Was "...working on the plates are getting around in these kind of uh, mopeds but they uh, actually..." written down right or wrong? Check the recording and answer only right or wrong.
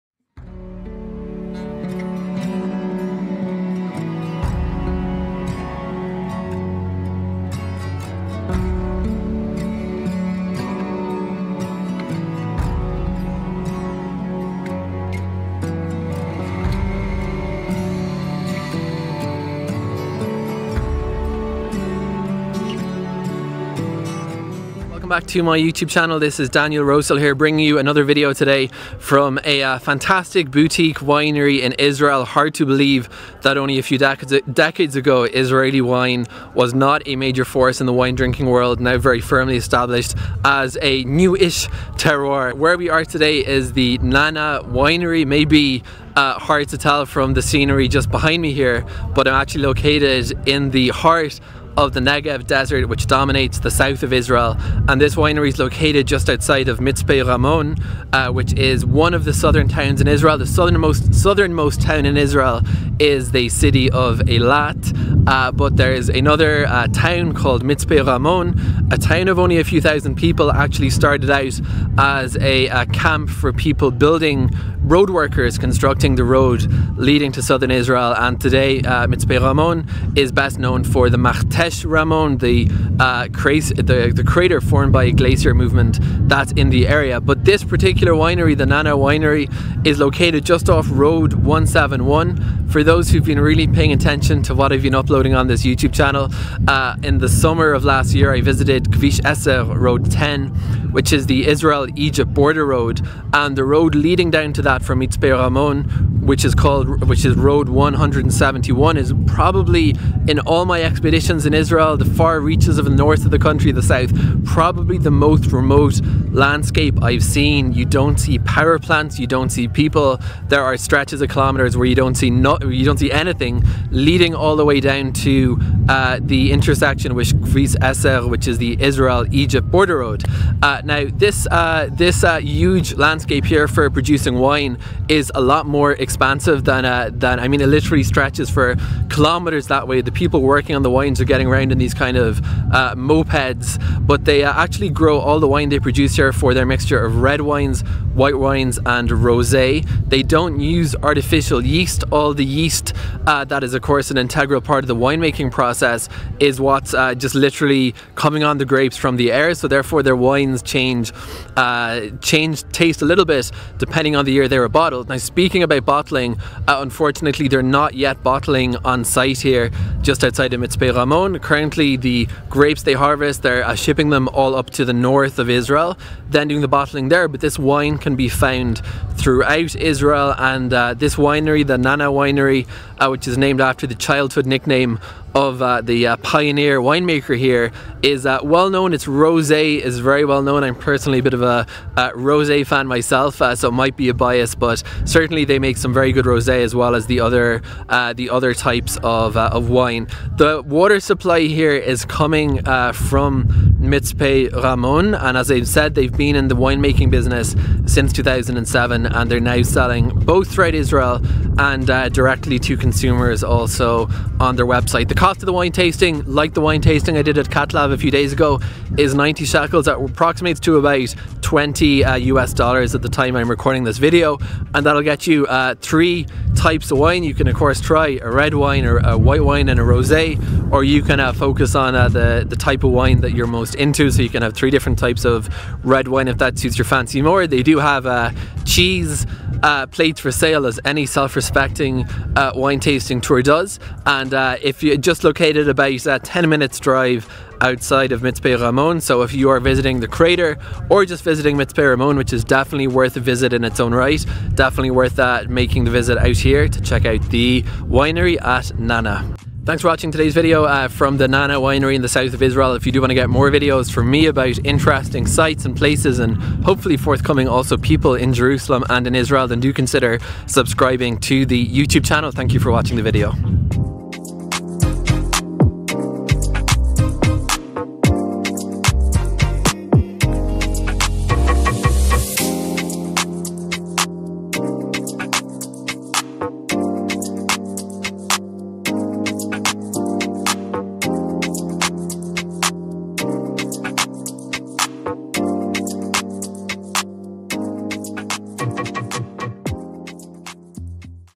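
wrong.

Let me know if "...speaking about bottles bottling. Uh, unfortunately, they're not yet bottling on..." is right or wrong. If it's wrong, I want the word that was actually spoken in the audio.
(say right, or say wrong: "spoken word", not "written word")
right.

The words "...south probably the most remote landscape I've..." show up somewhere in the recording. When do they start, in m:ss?
1:53.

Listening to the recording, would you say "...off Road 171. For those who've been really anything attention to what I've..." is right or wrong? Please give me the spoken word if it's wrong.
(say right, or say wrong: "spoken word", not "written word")
wrong: "paying", not "anything".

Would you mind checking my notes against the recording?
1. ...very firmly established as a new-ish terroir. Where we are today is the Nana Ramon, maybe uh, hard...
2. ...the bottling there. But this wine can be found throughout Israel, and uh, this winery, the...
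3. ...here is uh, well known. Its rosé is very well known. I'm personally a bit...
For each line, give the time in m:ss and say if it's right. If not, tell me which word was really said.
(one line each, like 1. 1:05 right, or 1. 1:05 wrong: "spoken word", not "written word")
1. 0:38 wrong: "Winery", not "Ramon"
2. 2:56 right
3. 3:07 right.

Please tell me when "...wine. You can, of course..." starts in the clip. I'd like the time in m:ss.
3:46.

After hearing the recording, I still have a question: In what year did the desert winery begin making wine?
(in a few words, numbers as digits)
2007.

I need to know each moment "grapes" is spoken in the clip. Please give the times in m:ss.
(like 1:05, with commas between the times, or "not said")
2:38, 2:52.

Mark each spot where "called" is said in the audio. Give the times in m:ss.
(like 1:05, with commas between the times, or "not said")
1:07, 1:46.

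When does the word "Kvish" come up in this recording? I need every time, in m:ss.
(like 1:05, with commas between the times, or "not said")
1:38, 2:07.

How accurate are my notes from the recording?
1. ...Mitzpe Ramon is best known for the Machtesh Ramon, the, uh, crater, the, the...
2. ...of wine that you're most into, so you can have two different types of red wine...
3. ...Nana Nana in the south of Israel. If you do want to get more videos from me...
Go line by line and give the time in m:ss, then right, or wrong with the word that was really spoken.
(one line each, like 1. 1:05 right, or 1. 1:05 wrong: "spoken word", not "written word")
1. 1:19 right
2. 3:52 wrong: "three", not "two"
3. 4:21 wrong: "Winery", not "Nana".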